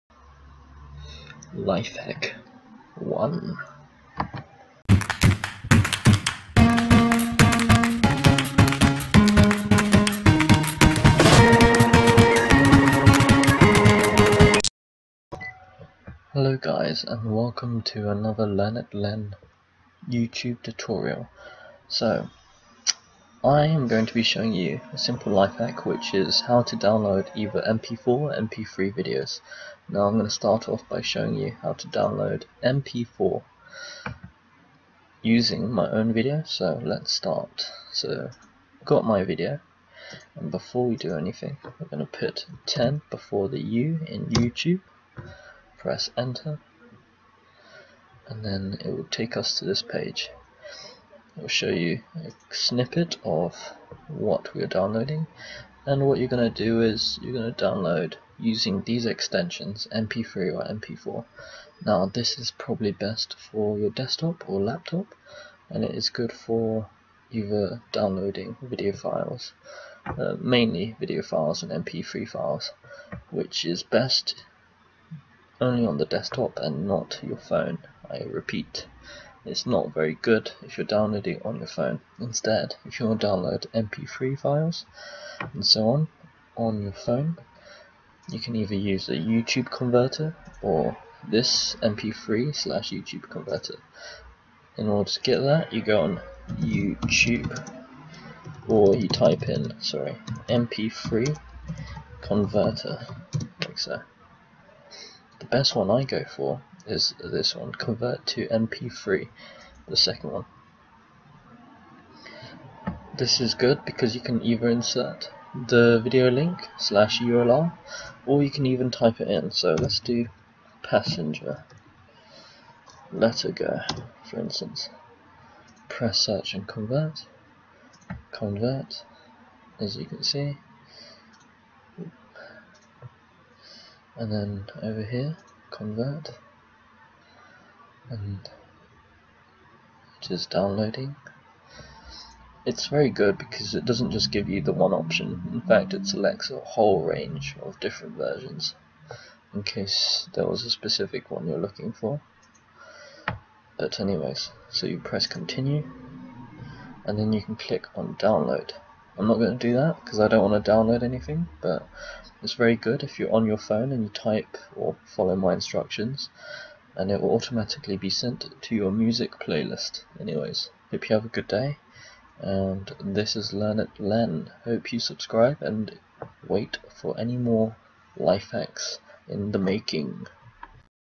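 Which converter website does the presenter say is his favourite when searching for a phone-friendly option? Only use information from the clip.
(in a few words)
Convert to MP3.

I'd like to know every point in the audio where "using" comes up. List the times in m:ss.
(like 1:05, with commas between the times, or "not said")
0:35, 0:58.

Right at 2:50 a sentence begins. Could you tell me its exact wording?
Anyways, hope you have a good day, and this is Learn It Len.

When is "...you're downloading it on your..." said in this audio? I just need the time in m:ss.
1:20.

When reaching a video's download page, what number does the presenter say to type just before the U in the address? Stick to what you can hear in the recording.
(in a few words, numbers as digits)
10.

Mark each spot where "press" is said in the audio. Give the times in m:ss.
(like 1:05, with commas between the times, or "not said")
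0:45, 2:05, 2:34.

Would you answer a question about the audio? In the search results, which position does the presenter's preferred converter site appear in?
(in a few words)
Second.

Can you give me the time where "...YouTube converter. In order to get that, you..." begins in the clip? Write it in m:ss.
1:32.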